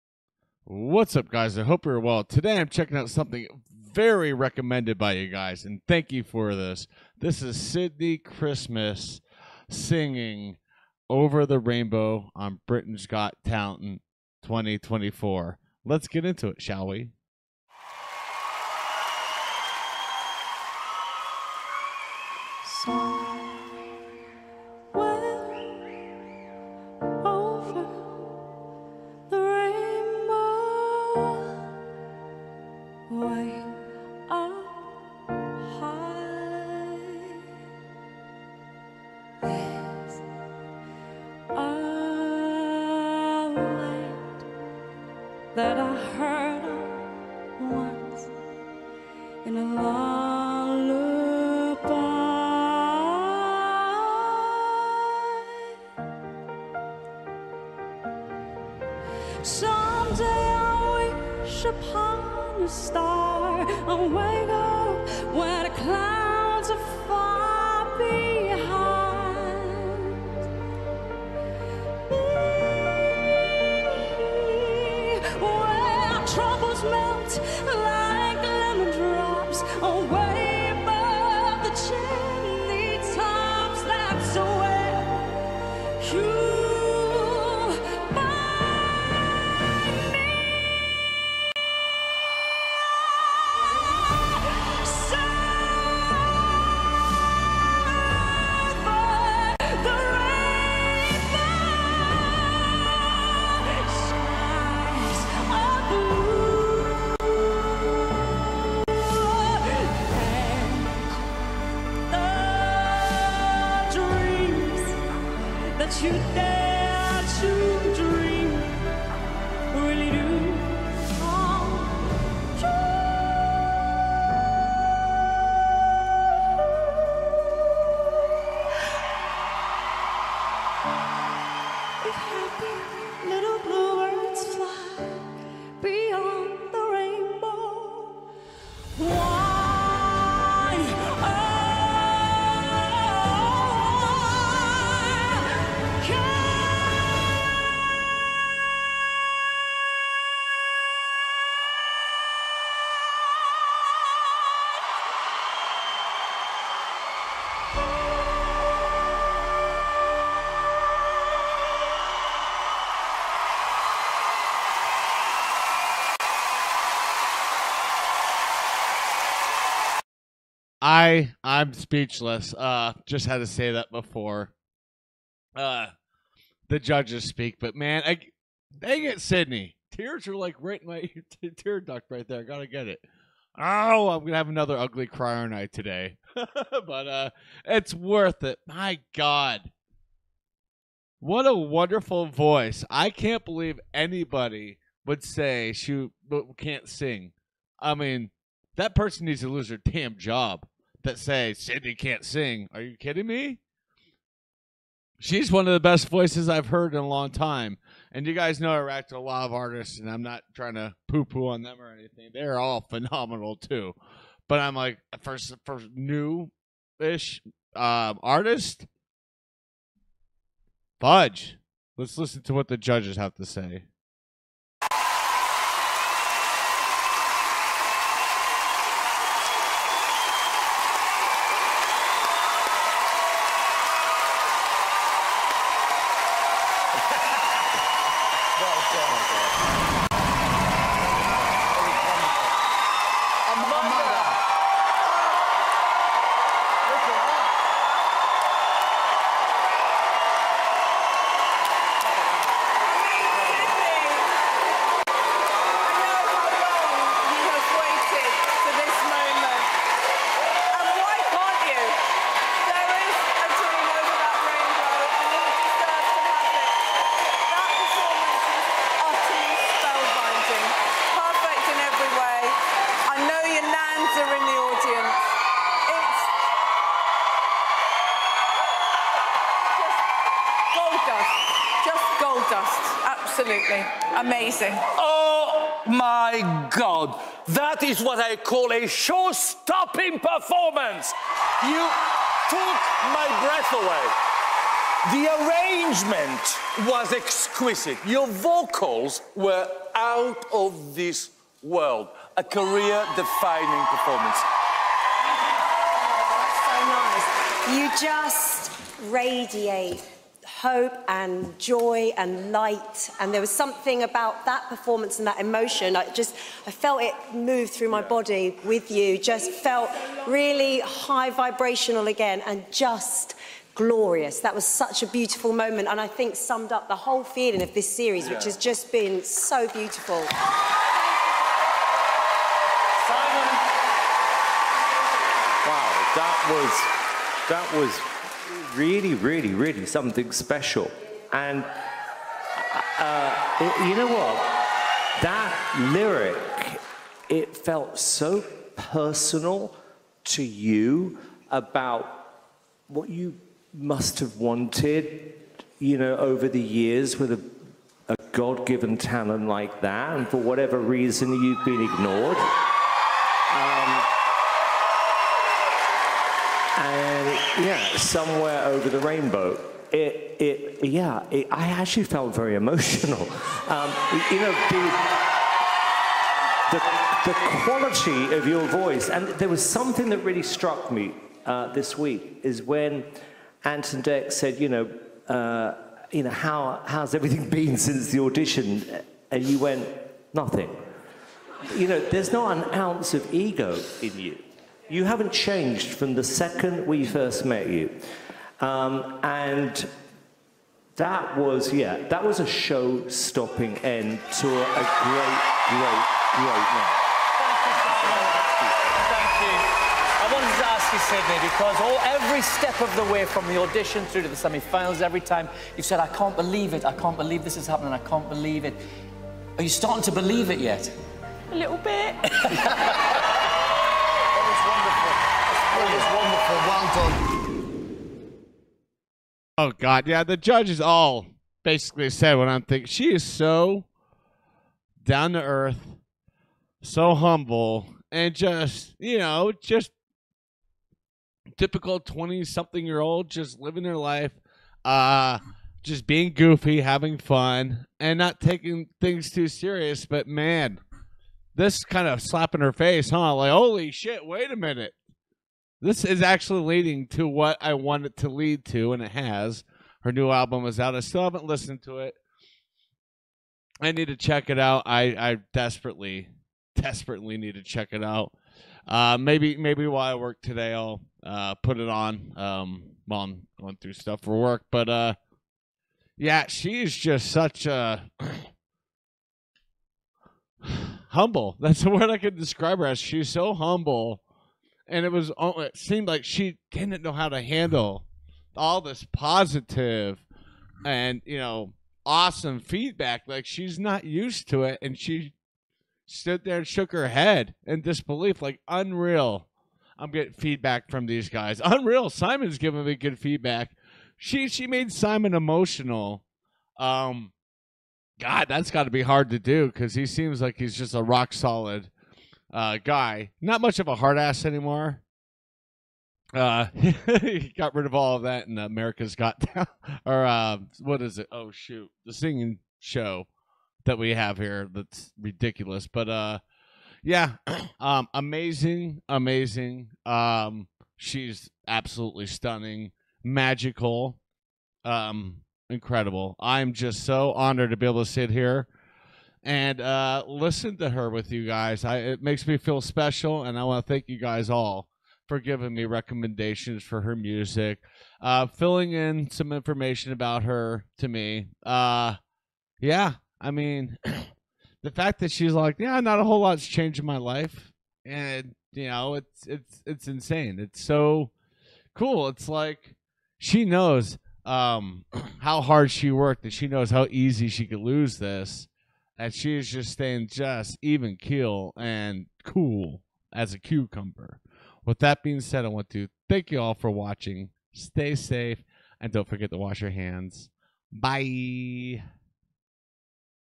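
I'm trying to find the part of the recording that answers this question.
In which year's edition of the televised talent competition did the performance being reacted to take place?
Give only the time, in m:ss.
0:14.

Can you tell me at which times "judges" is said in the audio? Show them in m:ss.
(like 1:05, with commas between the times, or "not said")
2:56, 3:42, 7:10.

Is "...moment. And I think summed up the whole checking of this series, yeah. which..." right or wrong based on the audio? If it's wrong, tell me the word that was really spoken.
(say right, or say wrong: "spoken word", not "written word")
wrong: "feeling", not "checking".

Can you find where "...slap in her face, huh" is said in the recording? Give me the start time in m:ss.
7:32.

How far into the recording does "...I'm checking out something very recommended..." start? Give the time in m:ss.
0:02.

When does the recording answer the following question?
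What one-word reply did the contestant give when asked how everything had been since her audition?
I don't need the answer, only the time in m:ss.
6:30.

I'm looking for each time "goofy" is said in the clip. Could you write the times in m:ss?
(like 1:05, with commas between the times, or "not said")
7:26.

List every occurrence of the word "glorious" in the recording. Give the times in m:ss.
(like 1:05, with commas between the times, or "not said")
5:23.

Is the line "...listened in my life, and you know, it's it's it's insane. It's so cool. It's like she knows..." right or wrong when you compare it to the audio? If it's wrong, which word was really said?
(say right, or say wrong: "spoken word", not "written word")
wrong: "changed", not "listened".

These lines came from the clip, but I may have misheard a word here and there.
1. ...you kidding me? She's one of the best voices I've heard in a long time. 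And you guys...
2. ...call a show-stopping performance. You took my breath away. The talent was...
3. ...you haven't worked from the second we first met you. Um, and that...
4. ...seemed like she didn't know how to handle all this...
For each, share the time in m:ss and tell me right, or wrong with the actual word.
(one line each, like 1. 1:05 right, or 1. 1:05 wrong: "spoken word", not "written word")
1. 3:22 right
2. 4:48 wrong: "arrangement", not "talent"
3. 6:34 wrong: "changed", not "worked"
4. 8:05 right.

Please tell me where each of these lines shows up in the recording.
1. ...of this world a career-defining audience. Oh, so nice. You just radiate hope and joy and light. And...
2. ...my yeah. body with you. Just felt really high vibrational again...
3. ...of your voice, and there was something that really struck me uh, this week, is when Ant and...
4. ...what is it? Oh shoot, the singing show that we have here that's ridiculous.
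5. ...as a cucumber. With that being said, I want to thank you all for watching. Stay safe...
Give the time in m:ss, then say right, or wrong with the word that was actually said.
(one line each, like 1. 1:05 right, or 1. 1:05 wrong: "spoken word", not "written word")
1. 5:00 wrong: "performance", not "audience"
2. 5:17 right
3. 6:18 right
4. 8:40 right
5. 9:33 right.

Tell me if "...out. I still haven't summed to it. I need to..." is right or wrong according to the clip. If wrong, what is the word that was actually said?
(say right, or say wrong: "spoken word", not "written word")
wrong: "listened", not "summed".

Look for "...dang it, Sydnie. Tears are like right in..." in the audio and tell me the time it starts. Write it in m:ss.
2:58.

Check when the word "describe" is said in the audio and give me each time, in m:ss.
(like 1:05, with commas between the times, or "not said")
8:02.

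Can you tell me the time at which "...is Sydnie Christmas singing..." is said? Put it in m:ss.
0:07.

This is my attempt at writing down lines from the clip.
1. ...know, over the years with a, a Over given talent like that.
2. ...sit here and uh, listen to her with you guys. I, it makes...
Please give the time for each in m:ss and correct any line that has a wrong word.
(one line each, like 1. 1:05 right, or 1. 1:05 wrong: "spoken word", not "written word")
1. 5:55 wrong: "God", not "Over"
2. 8:58 right.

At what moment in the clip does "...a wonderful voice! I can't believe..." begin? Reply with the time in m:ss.
3:11.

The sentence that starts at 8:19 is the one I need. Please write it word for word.
I'm getting feedback from these guys.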